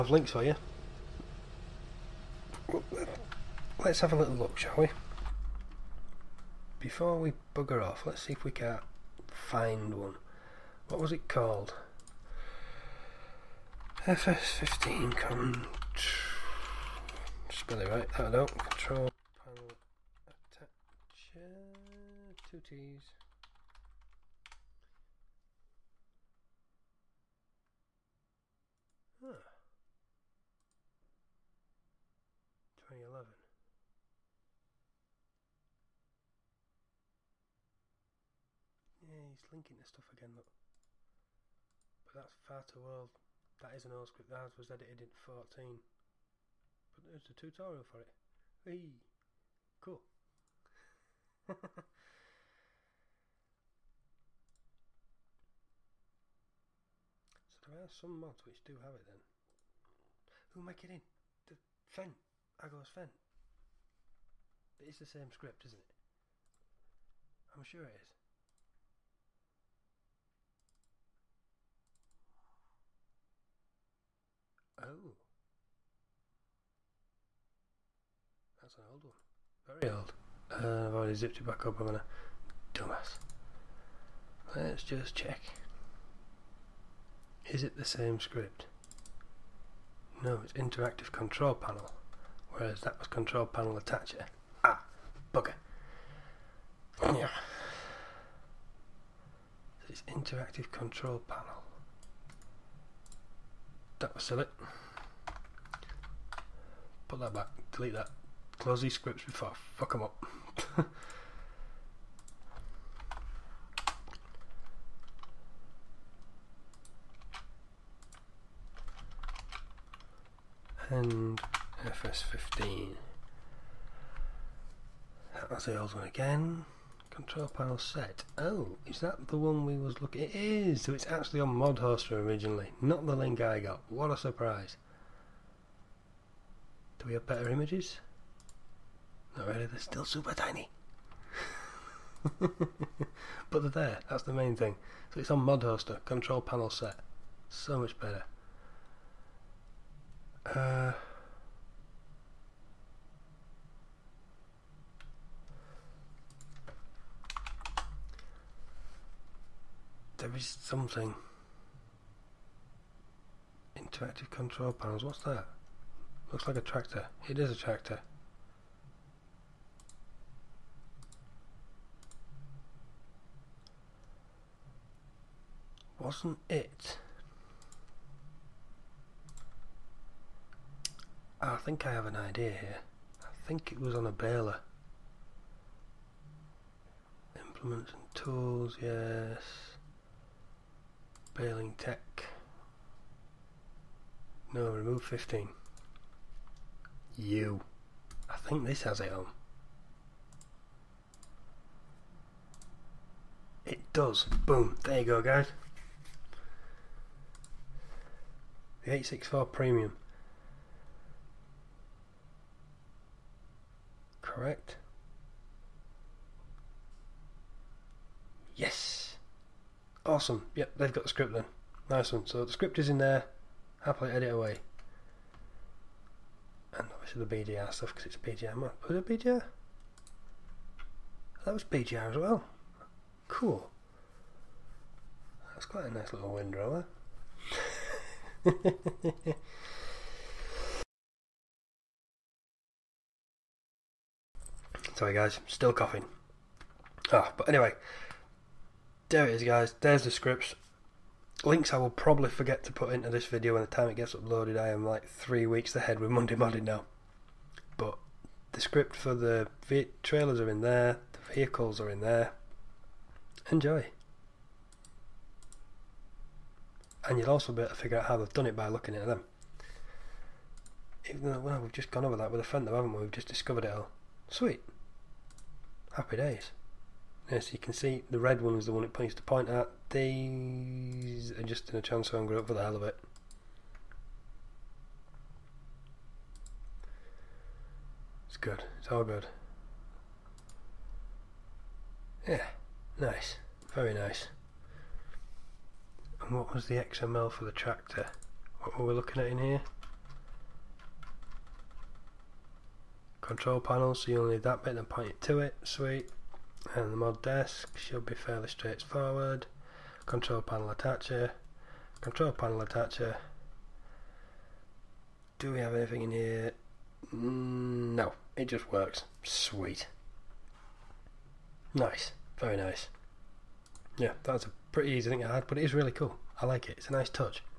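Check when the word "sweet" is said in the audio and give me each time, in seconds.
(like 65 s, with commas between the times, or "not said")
274 s, 305 s, 319 s.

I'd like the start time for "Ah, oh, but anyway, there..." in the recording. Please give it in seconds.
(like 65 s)
247 s.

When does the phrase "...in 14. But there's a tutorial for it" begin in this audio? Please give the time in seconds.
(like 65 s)
45 s.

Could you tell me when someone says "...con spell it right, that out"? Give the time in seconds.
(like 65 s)
15 s.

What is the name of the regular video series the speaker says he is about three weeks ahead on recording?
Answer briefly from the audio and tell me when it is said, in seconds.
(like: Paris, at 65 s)
Monday Modding, at 256 s.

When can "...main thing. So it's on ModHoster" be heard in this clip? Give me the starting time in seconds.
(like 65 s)
144 s.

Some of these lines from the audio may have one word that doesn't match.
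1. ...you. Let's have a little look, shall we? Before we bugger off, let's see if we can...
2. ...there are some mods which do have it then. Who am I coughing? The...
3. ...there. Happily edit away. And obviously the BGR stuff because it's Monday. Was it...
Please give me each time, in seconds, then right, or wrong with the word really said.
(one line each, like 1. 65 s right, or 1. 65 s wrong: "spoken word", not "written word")
1. 0 s right
2. 57 s wrong: "kidding", not "coughing"
3. 222 s wrong: "BGR", not "Monday".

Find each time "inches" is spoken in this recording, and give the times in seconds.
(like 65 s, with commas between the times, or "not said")
not said.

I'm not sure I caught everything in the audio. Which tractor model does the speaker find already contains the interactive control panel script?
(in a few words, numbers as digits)
864 Premium.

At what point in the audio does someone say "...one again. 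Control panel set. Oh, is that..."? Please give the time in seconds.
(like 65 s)
125 s.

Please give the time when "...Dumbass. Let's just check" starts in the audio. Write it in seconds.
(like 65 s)
82 s.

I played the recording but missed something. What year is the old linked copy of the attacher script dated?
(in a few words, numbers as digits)
2011.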